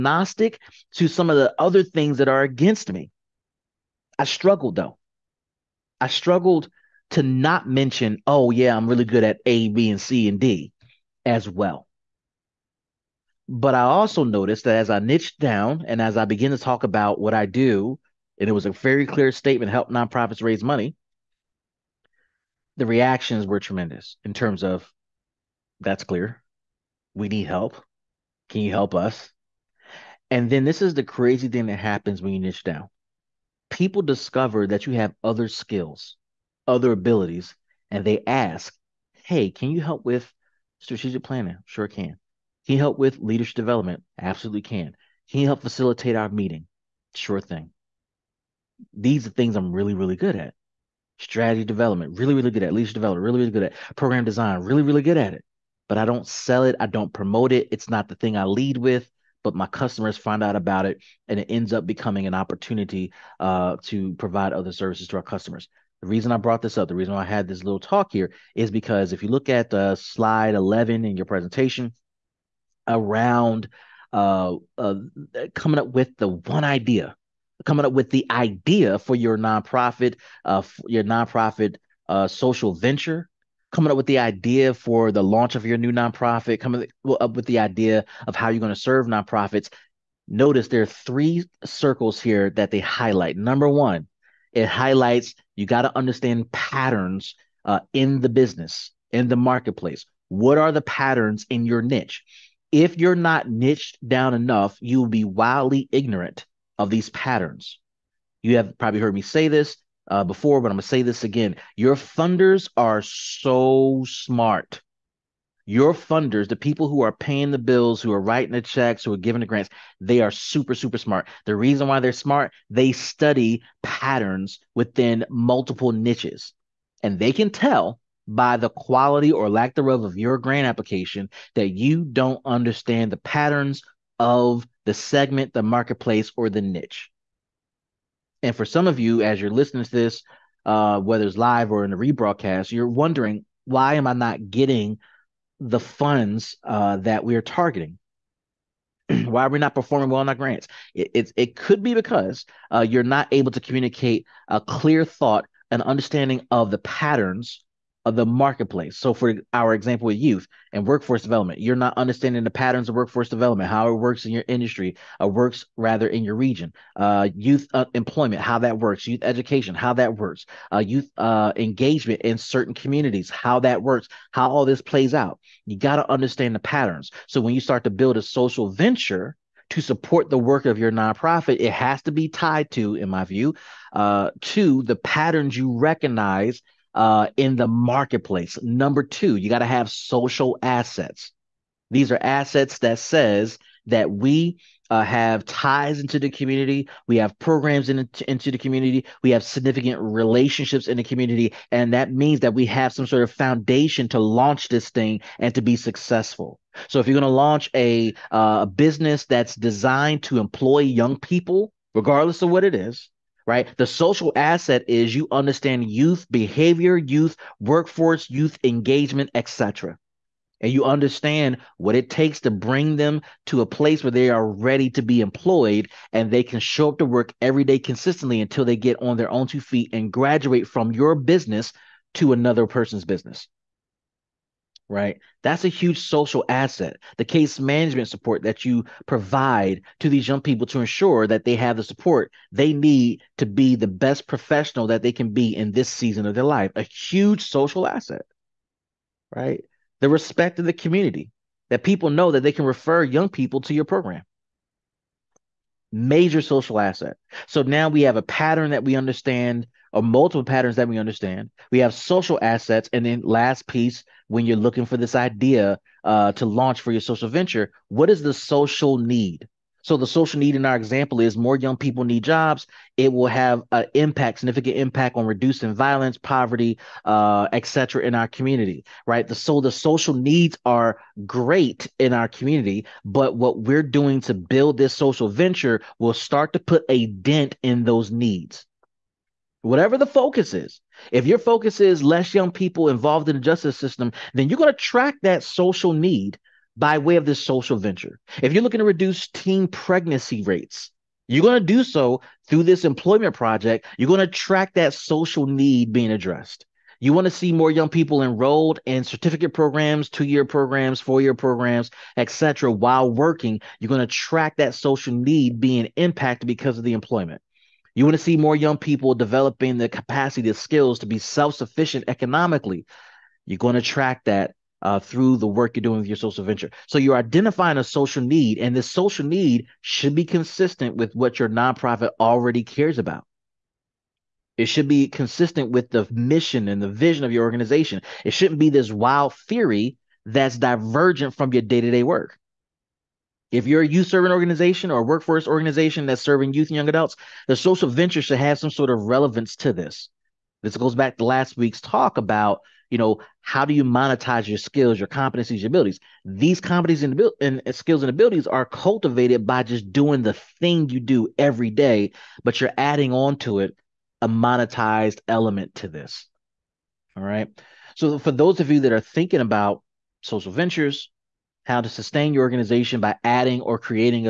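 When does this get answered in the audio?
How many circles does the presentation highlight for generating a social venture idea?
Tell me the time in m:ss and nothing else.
1:30.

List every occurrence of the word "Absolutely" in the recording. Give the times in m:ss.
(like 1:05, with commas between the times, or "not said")
0:44.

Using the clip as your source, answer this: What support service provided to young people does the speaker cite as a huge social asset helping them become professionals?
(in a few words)
Case management.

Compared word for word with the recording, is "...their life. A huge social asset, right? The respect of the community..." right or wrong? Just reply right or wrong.
right.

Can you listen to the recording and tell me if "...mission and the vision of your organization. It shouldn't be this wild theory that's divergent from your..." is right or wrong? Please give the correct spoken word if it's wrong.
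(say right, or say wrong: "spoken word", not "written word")
right.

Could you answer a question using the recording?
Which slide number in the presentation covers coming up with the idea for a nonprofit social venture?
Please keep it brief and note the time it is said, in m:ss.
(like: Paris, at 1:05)
11, at 1:09.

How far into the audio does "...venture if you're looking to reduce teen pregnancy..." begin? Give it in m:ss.
4:57.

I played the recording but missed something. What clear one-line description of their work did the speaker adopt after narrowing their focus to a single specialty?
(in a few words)
Help nonprofits raise money.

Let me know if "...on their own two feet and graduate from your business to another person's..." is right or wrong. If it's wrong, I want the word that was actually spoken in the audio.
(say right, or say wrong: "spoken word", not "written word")
right.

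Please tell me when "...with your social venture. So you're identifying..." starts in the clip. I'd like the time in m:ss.
5:25.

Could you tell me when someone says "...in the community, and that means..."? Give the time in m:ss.
3:20.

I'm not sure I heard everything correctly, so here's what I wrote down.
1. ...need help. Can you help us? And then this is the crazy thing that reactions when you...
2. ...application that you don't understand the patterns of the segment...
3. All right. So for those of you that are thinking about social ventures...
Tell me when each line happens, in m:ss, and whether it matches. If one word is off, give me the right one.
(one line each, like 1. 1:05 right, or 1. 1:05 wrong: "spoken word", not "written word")
1. 0:27 wrong: "happens", not "reactions"
2. 2:10 right
3. 6:07 right.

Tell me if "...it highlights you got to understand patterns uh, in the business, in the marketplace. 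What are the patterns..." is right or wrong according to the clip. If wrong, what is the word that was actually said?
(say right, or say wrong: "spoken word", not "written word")
right.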